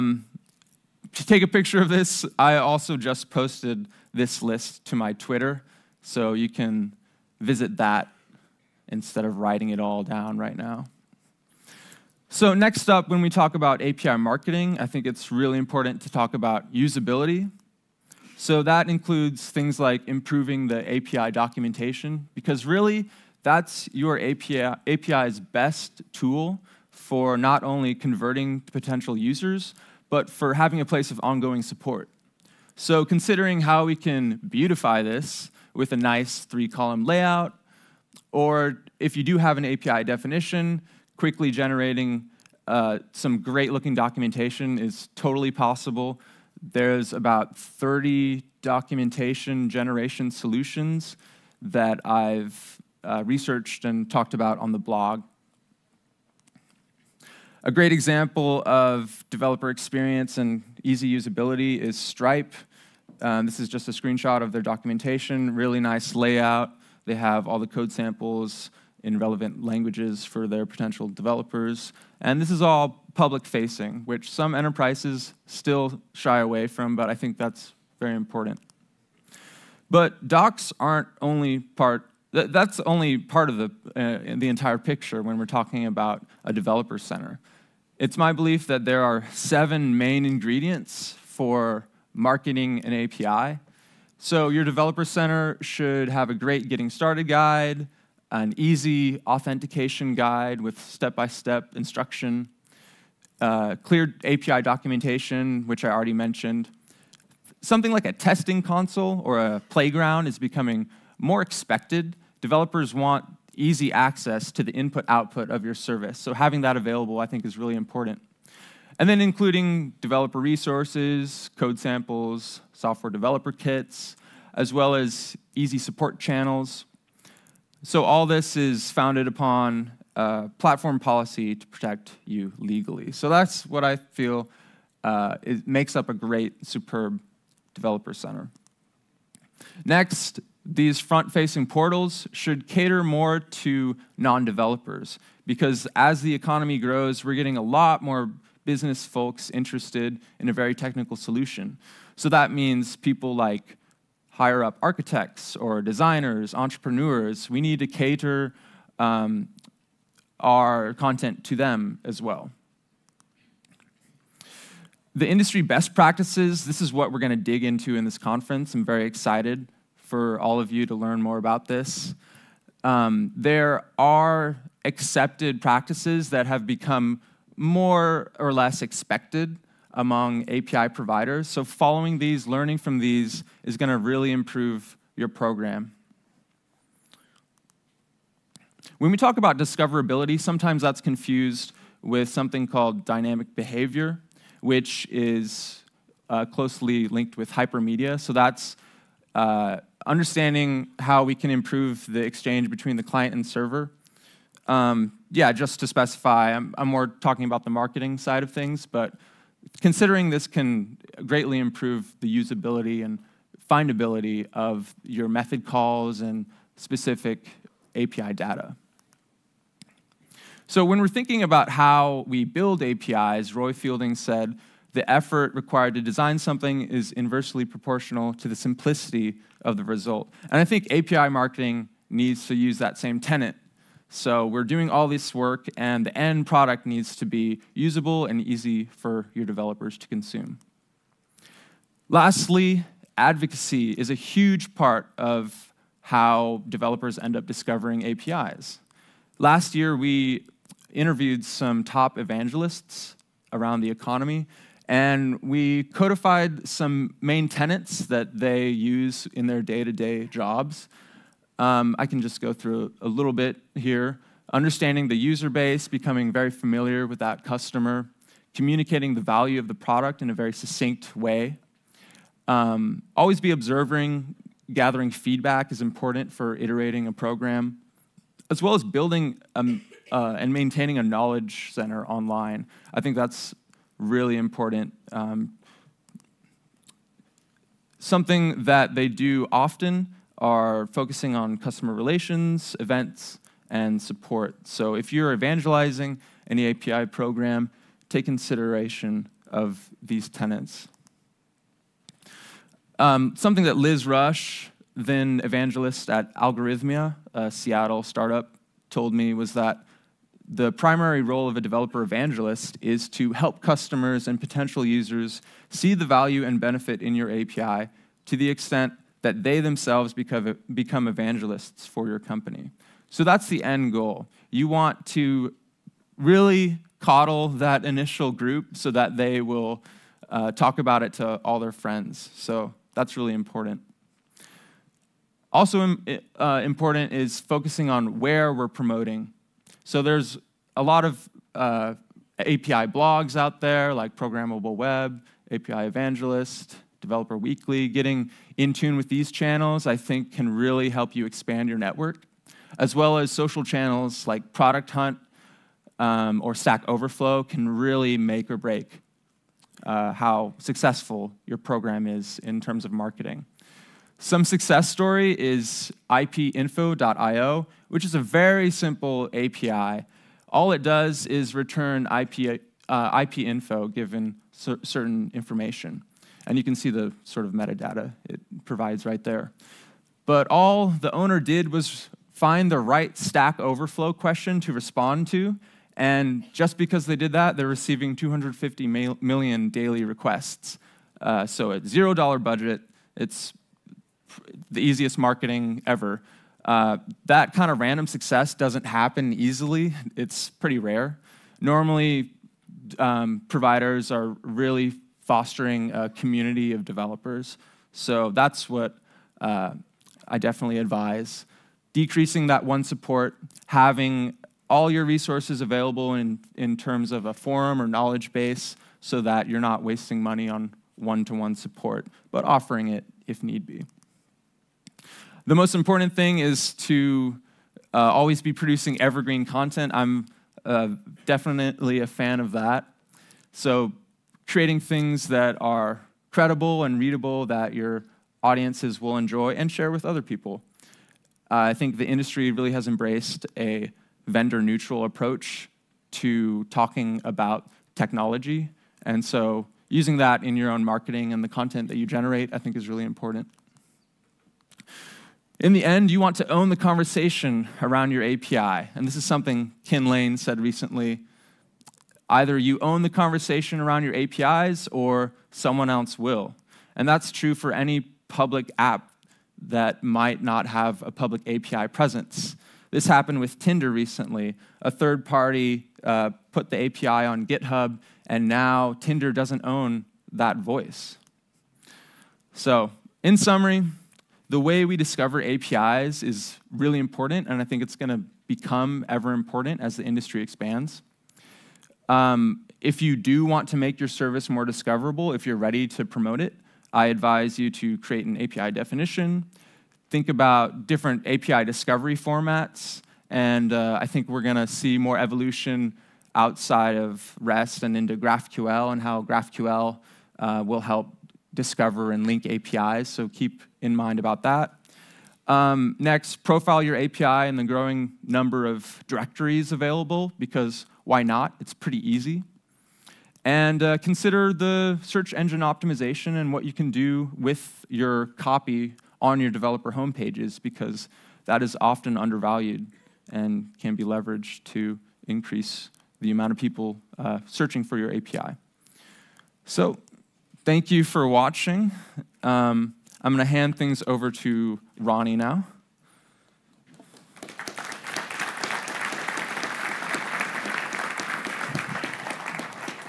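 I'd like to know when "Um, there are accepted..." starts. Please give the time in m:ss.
2:52.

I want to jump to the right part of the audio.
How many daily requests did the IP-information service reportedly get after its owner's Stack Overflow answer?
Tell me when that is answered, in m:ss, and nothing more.
6:28.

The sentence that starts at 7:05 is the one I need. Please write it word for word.
The most important thing is to uh, always be producing evergreen content.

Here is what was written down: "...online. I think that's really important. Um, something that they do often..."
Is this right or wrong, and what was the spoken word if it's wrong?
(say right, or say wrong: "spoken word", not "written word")
right.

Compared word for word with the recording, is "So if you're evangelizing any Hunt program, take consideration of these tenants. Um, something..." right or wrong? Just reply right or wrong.
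wrong.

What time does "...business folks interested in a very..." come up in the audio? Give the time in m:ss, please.
2:28.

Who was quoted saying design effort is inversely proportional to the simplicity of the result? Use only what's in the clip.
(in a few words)
Roy Fielding.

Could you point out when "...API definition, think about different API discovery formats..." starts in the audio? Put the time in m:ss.
8:18.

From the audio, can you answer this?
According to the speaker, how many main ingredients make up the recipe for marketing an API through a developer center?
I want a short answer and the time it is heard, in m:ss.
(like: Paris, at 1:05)
7, at 1:29.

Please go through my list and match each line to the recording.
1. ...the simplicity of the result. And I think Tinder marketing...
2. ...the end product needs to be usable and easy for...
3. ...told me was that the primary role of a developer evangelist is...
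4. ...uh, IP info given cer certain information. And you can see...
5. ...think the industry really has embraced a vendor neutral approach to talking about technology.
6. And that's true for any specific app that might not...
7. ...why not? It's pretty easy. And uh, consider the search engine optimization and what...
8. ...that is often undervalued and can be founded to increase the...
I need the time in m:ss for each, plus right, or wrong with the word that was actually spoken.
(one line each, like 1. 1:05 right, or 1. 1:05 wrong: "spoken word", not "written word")
1. 3:48 wrong: "API", not "Tinder"
2. 3:56 right
3. 5:08 right
4. 6:12 right
5. 7:21 right
6. 7:46 wrong: "public", not "specific"
7. 8:41 right
8. 8:51 wrong: "leveraged", not "founded".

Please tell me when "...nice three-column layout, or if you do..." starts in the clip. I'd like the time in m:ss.
0:35.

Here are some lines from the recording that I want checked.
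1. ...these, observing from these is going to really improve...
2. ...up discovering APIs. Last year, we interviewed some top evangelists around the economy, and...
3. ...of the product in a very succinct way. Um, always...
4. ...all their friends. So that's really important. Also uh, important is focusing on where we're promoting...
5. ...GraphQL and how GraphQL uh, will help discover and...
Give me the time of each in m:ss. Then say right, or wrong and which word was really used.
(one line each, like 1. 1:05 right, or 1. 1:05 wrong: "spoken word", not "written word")
1. 3:02 wrong: "learning", not "observing"
2. 4:07 right
3. 4:29 right
4. 5:31 right
5. 8:28 right.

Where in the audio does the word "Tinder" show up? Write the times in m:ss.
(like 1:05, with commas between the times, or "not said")
7:53, 7:58.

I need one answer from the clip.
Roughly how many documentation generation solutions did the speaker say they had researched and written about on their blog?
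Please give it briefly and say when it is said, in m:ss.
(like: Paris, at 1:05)
30, at 0:47.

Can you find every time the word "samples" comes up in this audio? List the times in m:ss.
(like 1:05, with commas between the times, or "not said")
1:07, 2:01.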